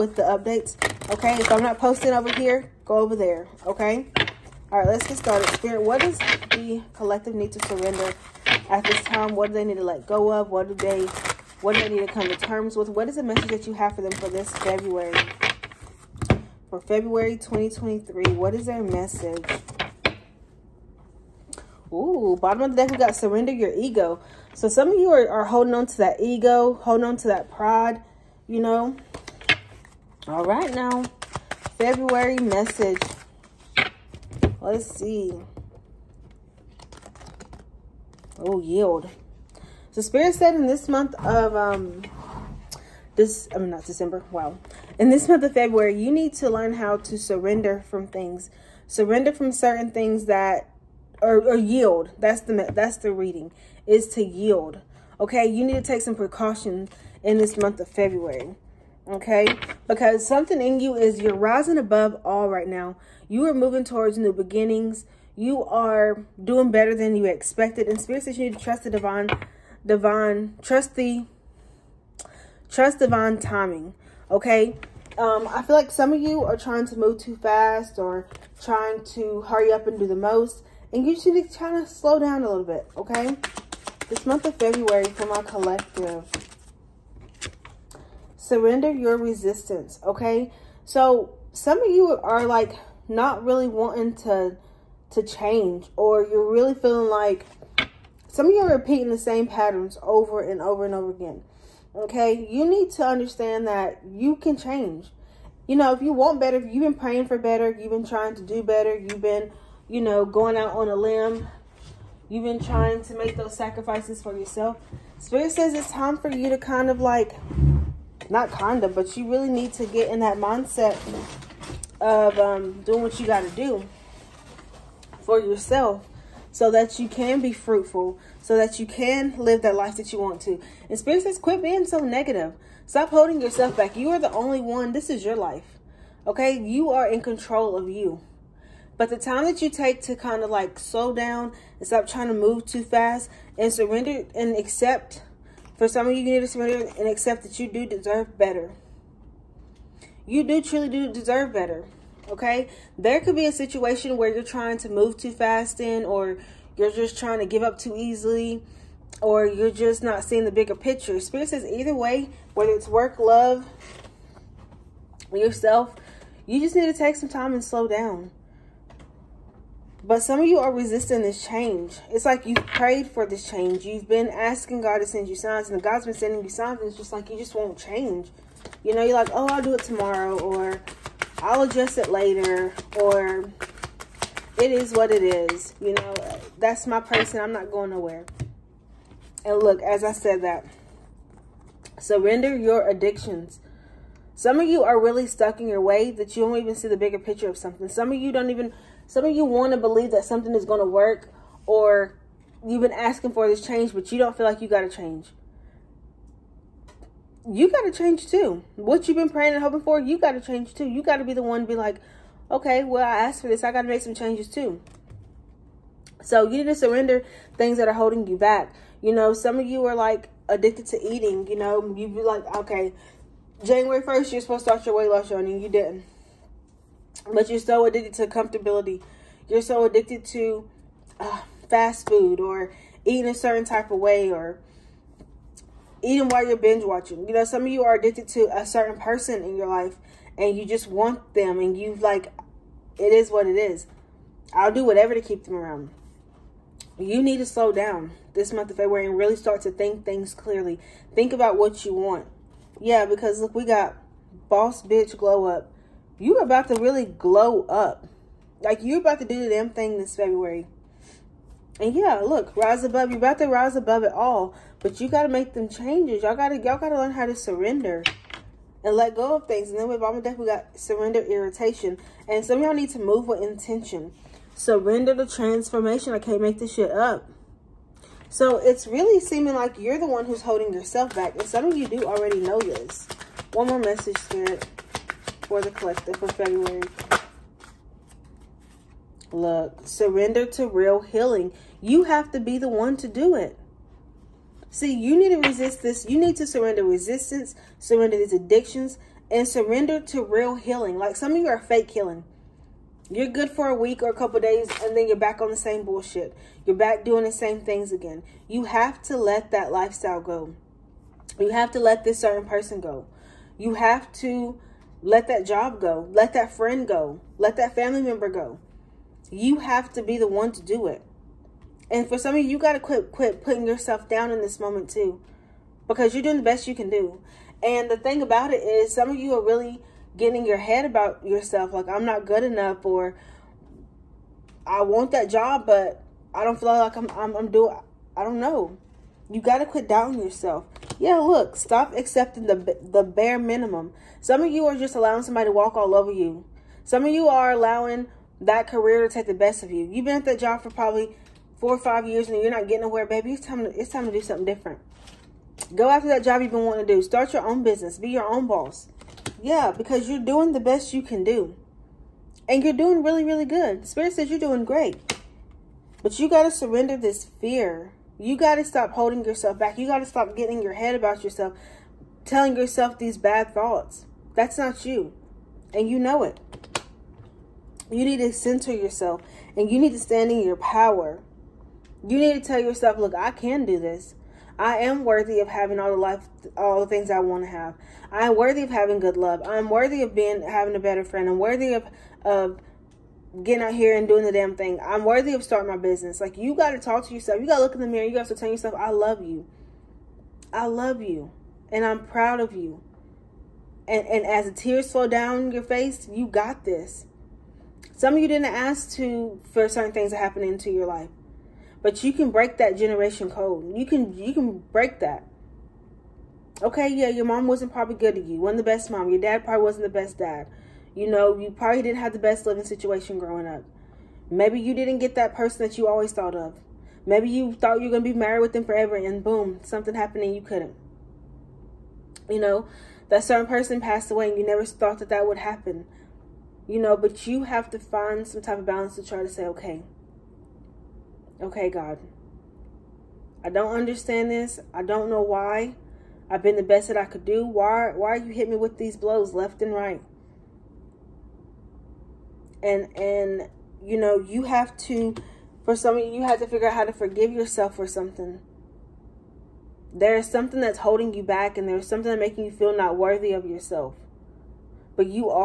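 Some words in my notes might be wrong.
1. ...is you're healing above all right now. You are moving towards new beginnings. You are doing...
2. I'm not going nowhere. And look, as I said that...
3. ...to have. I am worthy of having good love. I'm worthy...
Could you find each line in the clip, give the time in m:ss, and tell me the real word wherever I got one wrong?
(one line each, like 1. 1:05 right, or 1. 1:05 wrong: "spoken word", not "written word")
1. 1:00 wrong: "rising", not "healing"
2. 3:07 right
3. 6:27 right.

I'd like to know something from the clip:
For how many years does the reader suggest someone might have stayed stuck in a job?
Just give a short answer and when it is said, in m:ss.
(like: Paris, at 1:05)
4 or 5 years, at 5:51.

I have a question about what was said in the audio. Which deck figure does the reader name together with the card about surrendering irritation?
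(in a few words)
Mama Death.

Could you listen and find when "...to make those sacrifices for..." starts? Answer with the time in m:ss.
1:53.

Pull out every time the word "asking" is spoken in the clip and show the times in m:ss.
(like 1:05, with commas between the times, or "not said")
2:54, 3:22.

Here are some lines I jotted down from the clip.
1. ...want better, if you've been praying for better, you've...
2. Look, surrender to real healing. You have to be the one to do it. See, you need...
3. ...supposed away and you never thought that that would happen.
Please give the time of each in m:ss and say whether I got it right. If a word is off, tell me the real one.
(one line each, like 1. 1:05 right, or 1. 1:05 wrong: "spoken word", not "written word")
1. 1:46 right
2. 4:49 right
3. 7:13 wrong: "passed", not "supposed".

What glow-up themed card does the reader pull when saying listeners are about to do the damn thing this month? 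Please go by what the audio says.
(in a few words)
Boss bitch glow up.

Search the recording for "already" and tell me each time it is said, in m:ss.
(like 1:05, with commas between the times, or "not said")
4:42.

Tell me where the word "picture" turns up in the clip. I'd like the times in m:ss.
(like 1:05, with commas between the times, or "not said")
2:40, 3:17.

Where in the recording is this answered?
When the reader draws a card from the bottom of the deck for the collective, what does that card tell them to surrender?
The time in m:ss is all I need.
0:23.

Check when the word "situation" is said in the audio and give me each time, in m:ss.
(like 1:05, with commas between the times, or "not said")
2:33, 7:02.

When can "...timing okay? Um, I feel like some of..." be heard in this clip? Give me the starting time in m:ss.
1:13.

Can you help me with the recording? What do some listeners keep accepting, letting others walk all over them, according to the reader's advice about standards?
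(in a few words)
The bare minimum.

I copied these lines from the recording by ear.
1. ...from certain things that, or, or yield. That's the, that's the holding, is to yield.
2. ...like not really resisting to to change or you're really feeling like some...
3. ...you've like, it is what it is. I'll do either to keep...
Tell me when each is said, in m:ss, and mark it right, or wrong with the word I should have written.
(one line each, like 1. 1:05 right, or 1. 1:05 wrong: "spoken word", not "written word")
1. 0:49 wrong: "reading", not "holding"
2. 1:32 wrong: "wanting", not "resisting"
3. 4:01 wrong: "whatever", not "either".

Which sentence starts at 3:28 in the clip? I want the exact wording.
What you've been praying and hoping for, you got to change too.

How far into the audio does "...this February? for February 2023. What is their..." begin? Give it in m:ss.
0:14.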